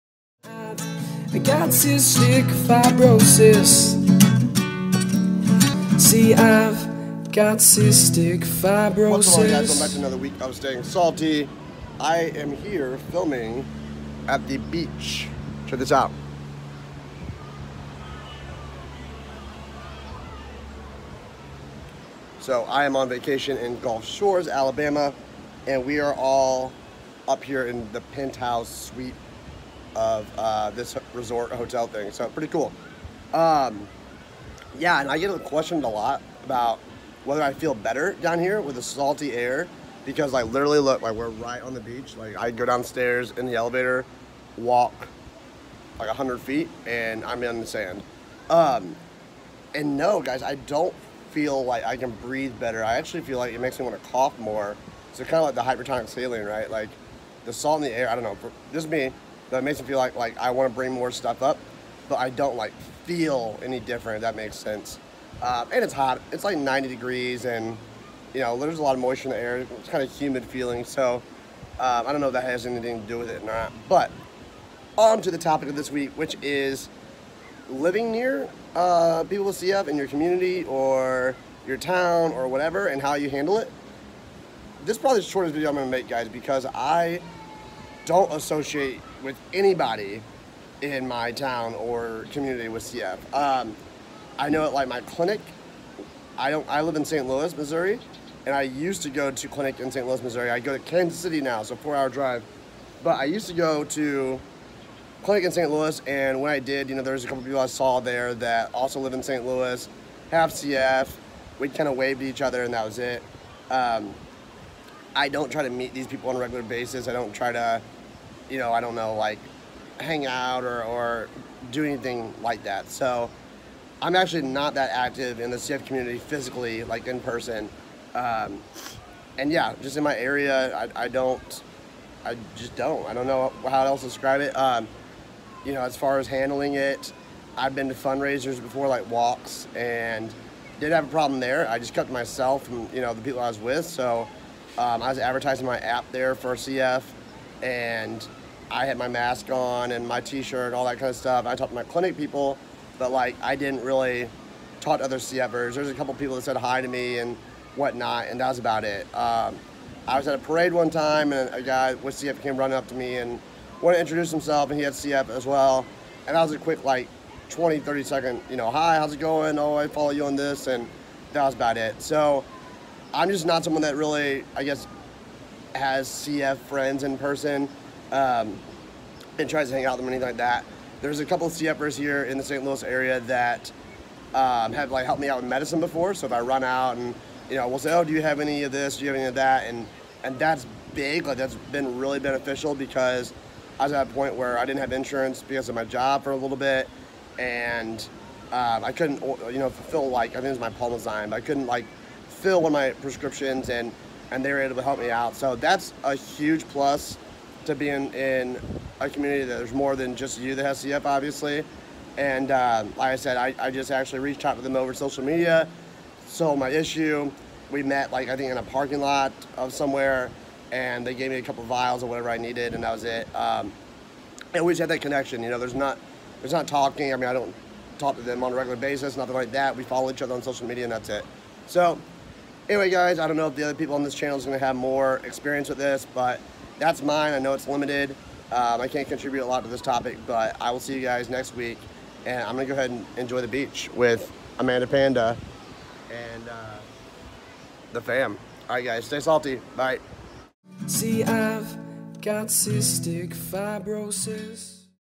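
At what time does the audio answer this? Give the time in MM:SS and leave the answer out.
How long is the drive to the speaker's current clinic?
01:41.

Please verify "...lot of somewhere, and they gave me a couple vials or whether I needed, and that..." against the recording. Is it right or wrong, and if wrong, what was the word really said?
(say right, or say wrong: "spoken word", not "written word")
wrong: "whatever", not "whether".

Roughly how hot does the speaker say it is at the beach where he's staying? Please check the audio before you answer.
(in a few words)
90 degrees.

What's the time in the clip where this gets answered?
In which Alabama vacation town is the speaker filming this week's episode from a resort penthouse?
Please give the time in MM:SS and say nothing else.
00:23.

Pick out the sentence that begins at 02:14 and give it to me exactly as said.
Um, you know, as far as handling it, I've been to fundraisers before, like walks, and did have a problem there.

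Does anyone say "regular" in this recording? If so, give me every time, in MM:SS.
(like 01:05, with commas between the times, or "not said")
01:56, 03:48.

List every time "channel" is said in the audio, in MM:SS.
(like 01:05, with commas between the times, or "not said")
03:54.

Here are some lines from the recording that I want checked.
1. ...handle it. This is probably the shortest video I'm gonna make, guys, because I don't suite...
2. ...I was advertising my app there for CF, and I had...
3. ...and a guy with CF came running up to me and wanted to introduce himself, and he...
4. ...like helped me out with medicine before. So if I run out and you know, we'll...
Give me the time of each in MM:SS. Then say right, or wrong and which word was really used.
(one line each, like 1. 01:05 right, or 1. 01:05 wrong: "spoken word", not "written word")
1. 01:23 wrong: "associate", not "suite"
2. 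02:25 right
3. 02:41 right
4. 03:04 right.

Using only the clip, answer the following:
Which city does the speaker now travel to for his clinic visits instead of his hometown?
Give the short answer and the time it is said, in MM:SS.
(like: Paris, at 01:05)
Kansas City, at 01:40.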